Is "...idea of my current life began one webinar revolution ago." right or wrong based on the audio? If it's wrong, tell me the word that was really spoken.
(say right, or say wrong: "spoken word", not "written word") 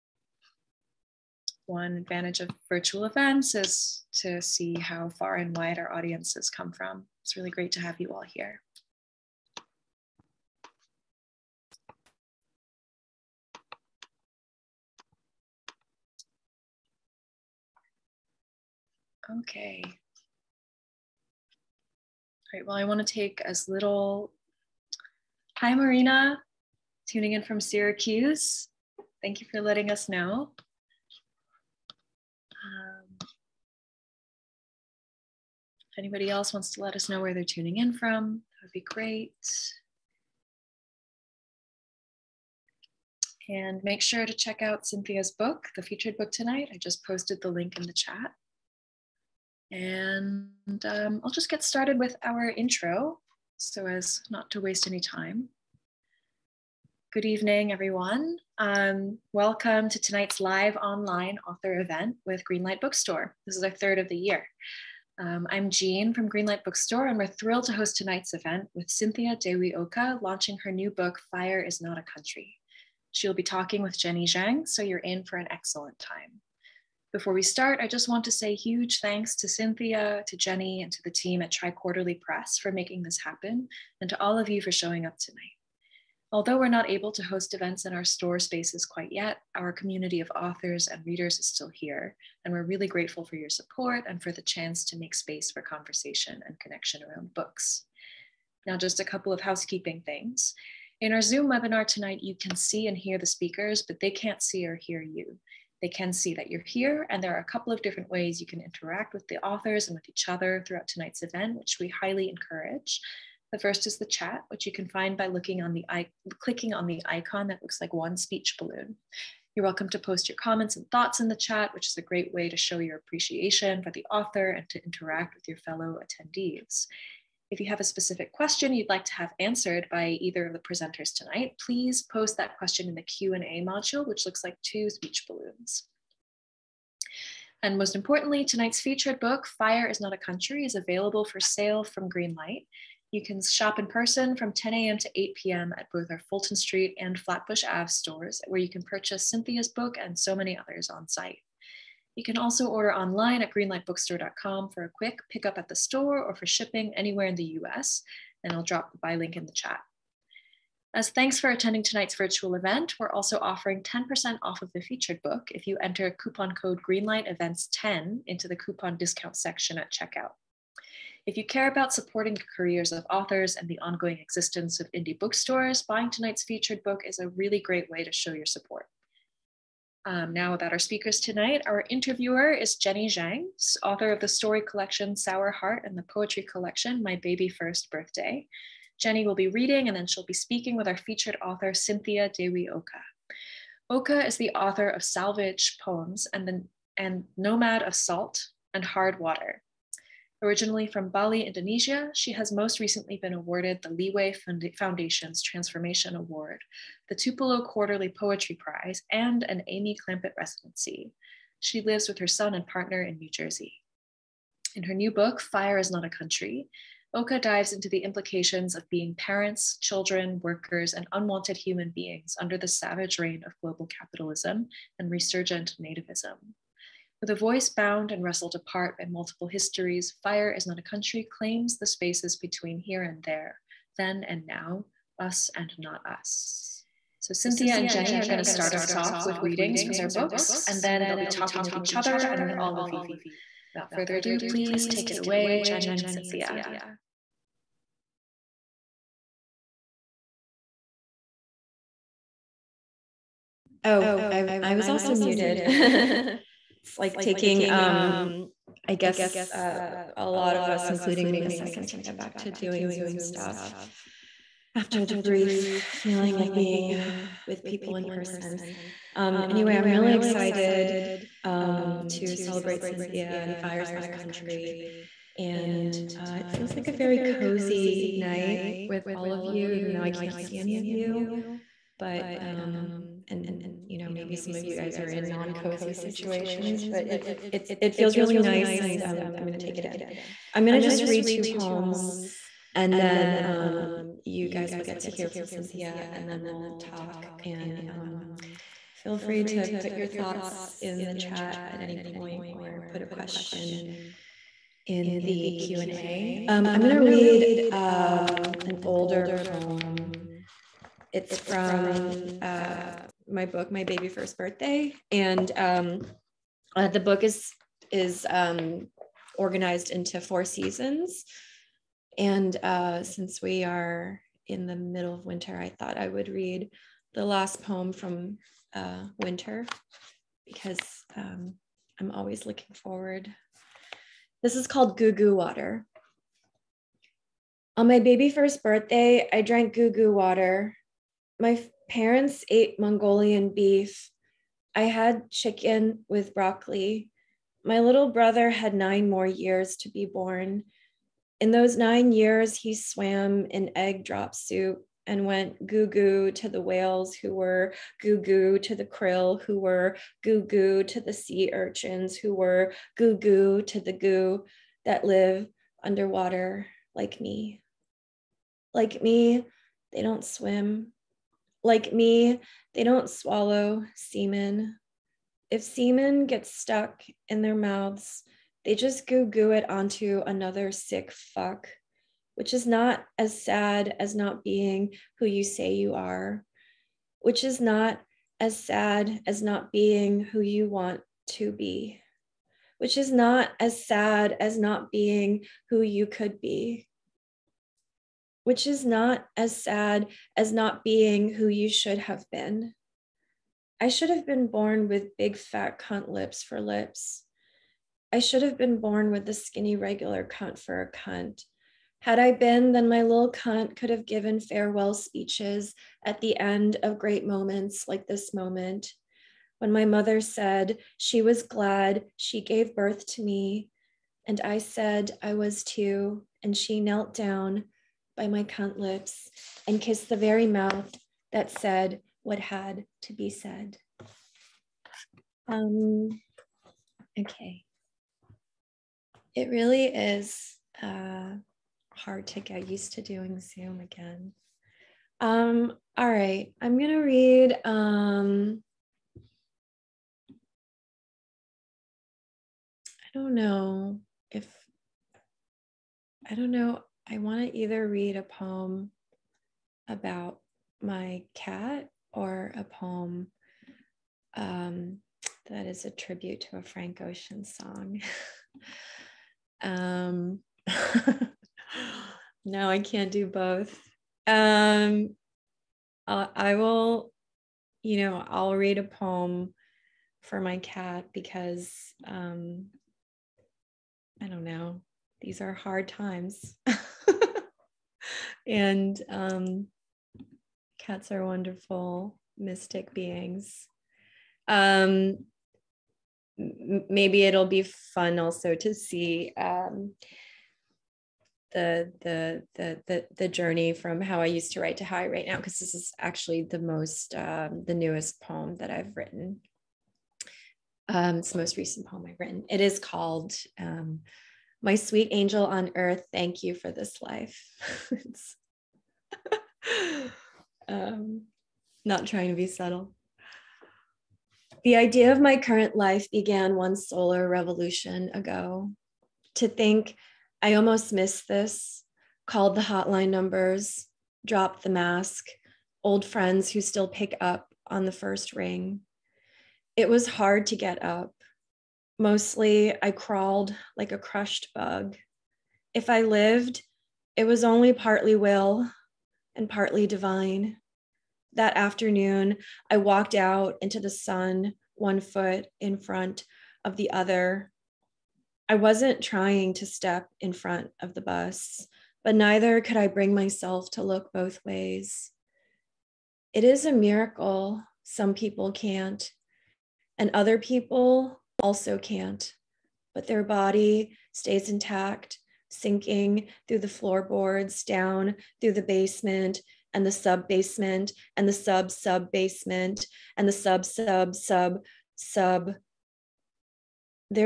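wrong: "solar", not "webinar".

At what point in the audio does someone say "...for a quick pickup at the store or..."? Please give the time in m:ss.
2:34.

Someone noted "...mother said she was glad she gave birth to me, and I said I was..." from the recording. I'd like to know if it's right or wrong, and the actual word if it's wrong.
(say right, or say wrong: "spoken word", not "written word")
right.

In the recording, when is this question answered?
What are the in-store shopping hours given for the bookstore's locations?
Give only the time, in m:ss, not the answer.
2:24.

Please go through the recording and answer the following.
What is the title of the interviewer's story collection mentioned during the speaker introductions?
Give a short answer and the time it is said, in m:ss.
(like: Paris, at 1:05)
Sour Heart, at 3:05.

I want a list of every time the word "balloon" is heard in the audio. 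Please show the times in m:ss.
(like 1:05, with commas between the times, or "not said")
1:58, 2:15.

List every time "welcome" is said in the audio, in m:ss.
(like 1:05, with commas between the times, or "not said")
0:59, 1:59.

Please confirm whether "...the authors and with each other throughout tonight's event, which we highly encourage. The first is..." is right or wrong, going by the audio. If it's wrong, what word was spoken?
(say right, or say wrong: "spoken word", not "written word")
right.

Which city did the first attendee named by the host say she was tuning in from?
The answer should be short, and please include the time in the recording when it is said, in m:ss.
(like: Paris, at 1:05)
Syracuse, at 0:27.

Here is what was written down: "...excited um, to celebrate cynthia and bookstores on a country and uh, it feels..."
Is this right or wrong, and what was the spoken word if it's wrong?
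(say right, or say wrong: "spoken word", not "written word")
wrong: "fires", not "bookstores".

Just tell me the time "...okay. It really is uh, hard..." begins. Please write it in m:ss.
7:17.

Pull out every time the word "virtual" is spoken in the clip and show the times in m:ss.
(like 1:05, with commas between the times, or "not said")
0:02, 2:42.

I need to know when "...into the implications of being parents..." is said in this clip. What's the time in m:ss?
3:37.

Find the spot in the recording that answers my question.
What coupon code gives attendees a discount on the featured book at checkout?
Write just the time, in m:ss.
2:46.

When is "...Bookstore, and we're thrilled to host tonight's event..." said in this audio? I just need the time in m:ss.
1:06.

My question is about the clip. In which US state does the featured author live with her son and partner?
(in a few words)
New Jersey.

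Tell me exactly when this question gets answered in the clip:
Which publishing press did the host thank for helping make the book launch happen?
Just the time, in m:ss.
1:21.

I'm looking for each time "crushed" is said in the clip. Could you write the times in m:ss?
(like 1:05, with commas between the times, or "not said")
9:03.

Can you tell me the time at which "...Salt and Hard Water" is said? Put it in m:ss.
3:17.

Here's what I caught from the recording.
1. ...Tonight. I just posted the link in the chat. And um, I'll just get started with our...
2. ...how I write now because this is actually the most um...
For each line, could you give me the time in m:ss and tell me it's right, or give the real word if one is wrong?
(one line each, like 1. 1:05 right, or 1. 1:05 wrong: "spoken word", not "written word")
1. 0:46 right
2. 8:24 right.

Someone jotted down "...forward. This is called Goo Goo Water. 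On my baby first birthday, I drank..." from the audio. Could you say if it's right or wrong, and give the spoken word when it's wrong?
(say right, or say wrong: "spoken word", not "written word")
right.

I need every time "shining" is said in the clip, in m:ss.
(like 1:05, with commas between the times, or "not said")
not said.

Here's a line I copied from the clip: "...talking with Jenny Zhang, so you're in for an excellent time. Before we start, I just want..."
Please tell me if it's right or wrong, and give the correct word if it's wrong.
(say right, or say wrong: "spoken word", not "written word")
right.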